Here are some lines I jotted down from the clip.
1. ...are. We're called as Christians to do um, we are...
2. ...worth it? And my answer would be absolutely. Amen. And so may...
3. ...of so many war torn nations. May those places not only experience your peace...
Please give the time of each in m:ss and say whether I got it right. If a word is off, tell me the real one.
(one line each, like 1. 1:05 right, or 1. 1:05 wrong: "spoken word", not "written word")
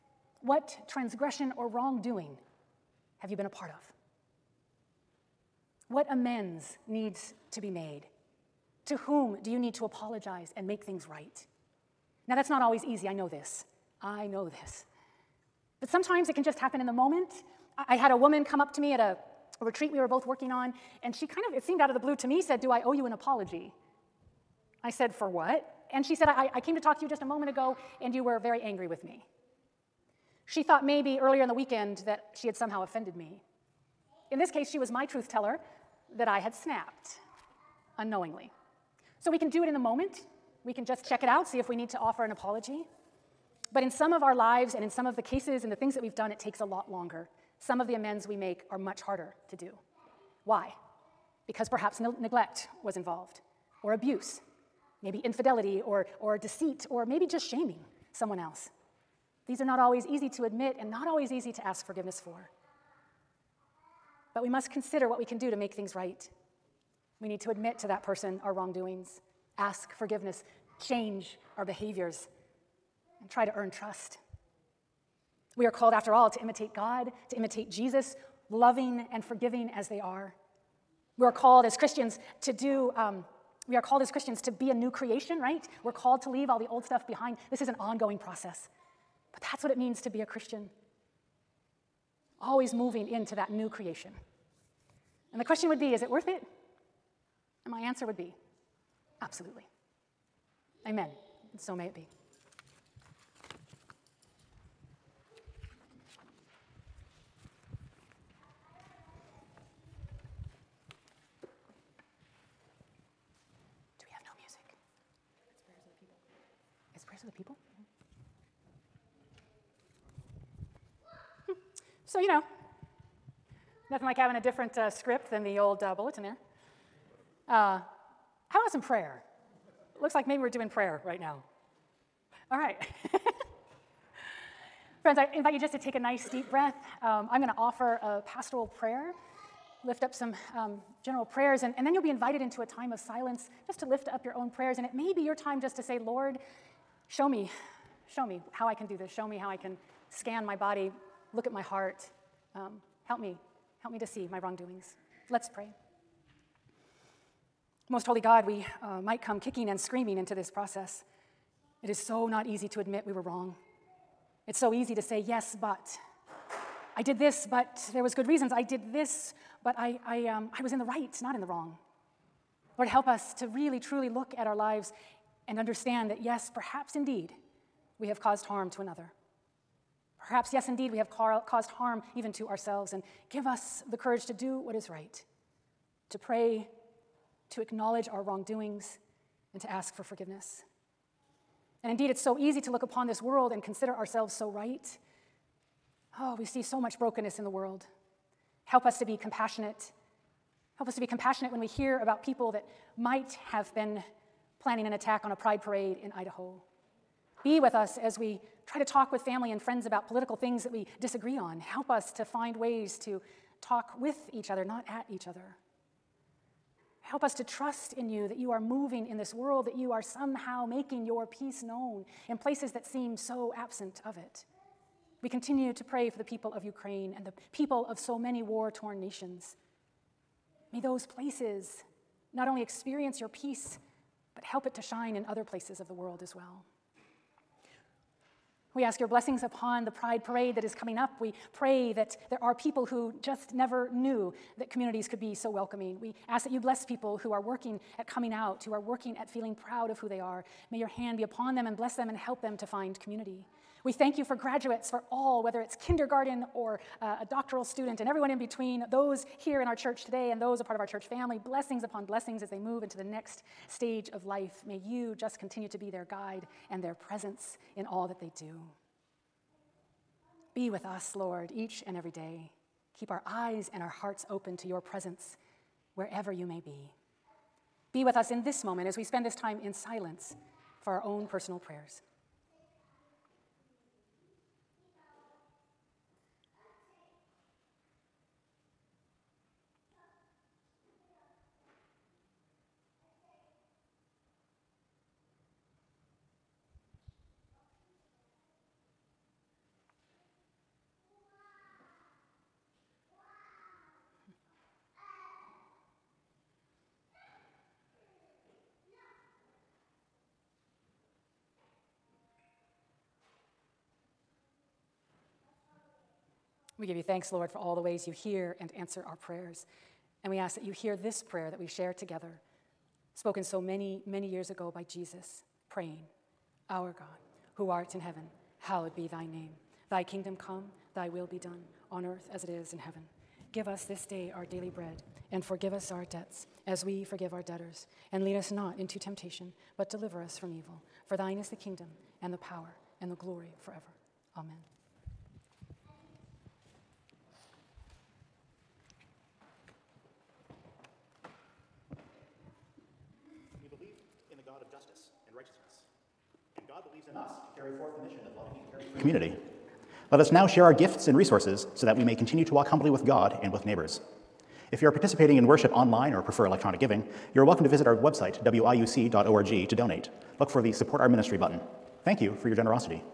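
1. 1:19 right
2. 1:36 right
3. 3:47 right.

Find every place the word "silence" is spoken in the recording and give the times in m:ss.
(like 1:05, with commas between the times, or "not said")
2:22, 4:39.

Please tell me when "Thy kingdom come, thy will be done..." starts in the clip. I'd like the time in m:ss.
5:29.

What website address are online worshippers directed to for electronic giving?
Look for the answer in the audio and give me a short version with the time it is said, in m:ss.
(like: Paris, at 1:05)
wiuc.org, at 6:08.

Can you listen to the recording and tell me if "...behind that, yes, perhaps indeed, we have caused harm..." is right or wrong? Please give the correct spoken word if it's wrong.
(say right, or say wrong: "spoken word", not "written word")
wrong: "understand", not "behind".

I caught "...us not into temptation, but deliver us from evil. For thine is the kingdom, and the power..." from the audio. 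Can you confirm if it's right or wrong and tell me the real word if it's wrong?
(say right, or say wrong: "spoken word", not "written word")
right.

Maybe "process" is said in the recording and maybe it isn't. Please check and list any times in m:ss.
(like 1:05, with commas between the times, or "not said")
1:28, 2:40.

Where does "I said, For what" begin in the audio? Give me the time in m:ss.
0:24.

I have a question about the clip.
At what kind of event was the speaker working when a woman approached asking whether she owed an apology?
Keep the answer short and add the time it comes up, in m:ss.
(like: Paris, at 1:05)
A retreat, at 0:19.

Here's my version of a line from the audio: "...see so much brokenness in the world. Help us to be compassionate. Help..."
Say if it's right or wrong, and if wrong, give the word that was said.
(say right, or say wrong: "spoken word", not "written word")
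right.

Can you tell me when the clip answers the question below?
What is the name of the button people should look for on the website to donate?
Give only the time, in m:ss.
6:10.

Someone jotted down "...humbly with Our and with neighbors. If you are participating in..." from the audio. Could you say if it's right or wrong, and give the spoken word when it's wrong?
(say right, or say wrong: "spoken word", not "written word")
wrong: "God", not "Our".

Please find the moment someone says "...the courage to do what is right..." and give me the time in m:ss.
3:03.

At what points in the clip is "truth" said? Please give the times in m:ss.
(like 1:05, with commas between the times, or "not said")
0:35.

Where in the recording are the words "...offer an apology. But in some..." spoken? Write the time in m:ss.
0:41.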